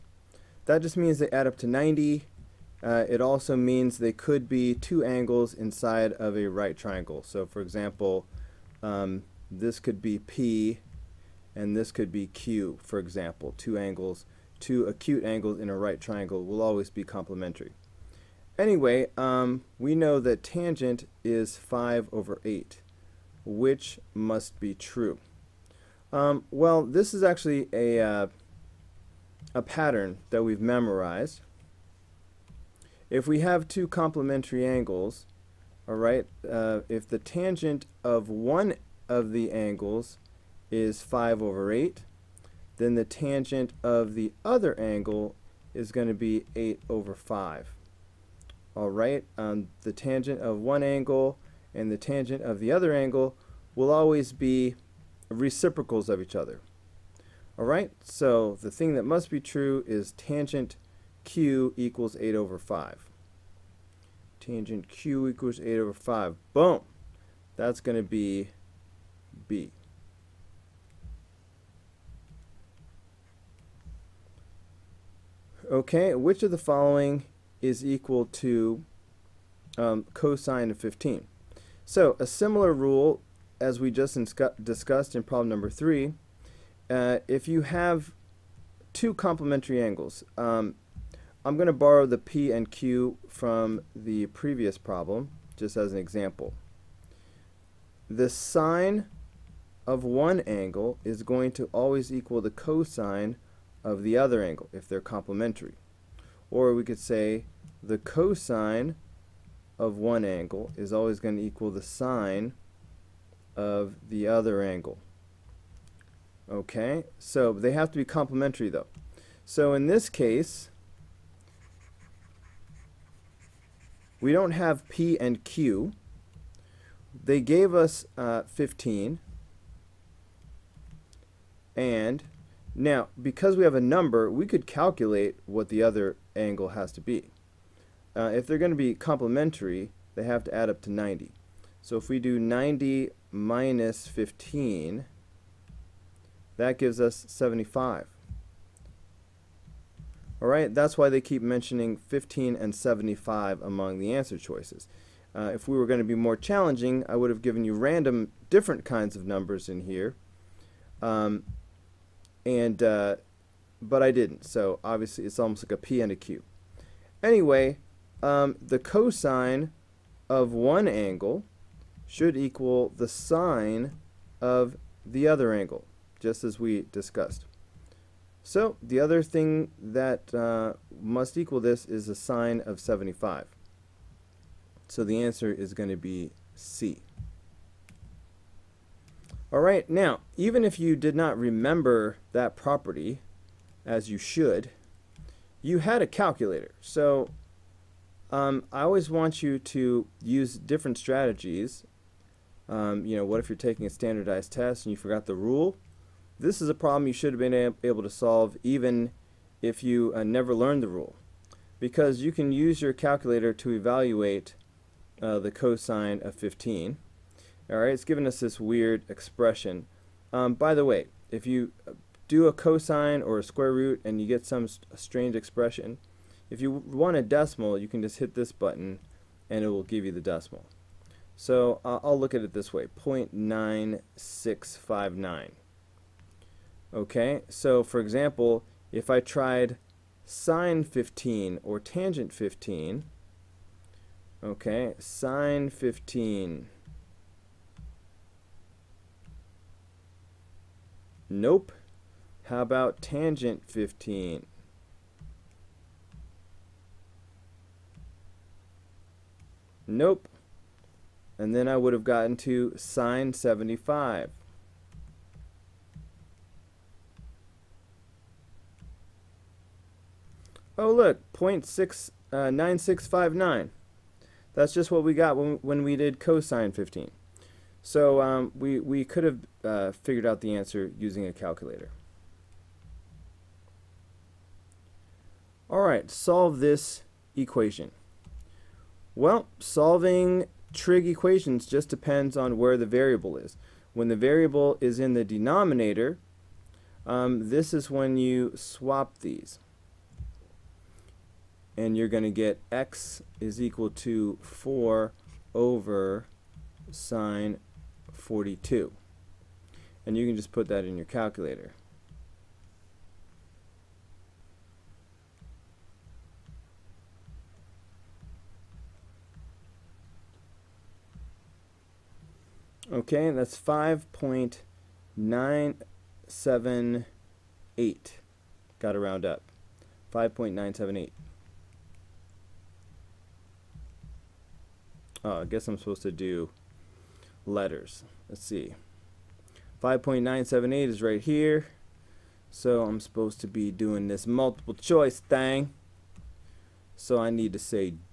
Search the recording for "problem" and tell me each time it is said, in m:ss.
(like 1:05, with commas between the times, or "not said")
1:25, 1:34, 3:26.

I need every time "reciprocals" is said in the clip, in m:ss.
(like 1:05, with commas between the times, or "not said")
0:55.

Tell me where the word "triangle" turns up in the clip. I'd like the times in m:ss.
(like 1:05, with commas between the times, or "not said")
0:06, 0:15.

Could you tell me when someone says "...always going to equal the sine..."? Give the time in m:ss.
1:50.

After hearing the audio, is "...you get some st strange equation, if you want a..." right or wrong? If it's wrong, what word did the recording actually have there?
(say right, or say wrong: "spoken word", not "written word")
wrong: "expression", not "equation".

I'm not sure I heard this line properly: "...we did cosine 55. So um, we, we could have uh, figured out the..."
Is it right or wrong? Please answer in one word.
wrong.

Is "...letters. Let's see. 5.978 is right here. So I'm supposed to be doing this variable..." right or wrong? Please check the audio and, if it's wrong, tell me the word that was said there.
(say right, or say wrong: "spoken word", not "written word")
wrong: "multiple", not "variable".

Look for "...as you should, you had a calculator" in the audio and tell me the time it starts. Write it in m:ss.
3:13.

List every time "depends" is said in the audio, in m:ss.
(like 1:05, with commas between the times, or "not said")
4:51.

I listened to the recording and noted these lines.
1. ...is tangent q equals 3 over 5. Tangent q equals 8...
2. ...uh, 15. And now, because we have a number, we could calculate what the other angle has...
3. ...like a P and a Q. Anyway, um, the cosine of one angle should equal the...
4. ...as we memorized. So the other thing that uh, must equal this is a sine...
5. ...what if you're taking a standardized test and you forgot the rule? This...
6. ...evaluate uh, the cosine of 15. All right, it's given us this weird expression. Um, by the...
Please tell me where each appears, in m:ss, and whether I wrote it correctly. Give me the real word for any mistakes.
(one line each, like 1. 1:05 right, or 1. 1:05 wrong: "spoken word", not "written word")
1. 0:59 wrong: "8", not "3"
2. 2:08 right
3. 2:45 right
4. 2:56 wrong: "discussed", not "memorized"
5. 3:23 right
6. 3:33 right.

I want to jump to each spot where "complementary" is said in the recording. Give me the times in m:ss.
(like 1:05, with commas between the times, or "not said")
0:17, 0:33, 1:29, 1:45, 1:58, 2:18.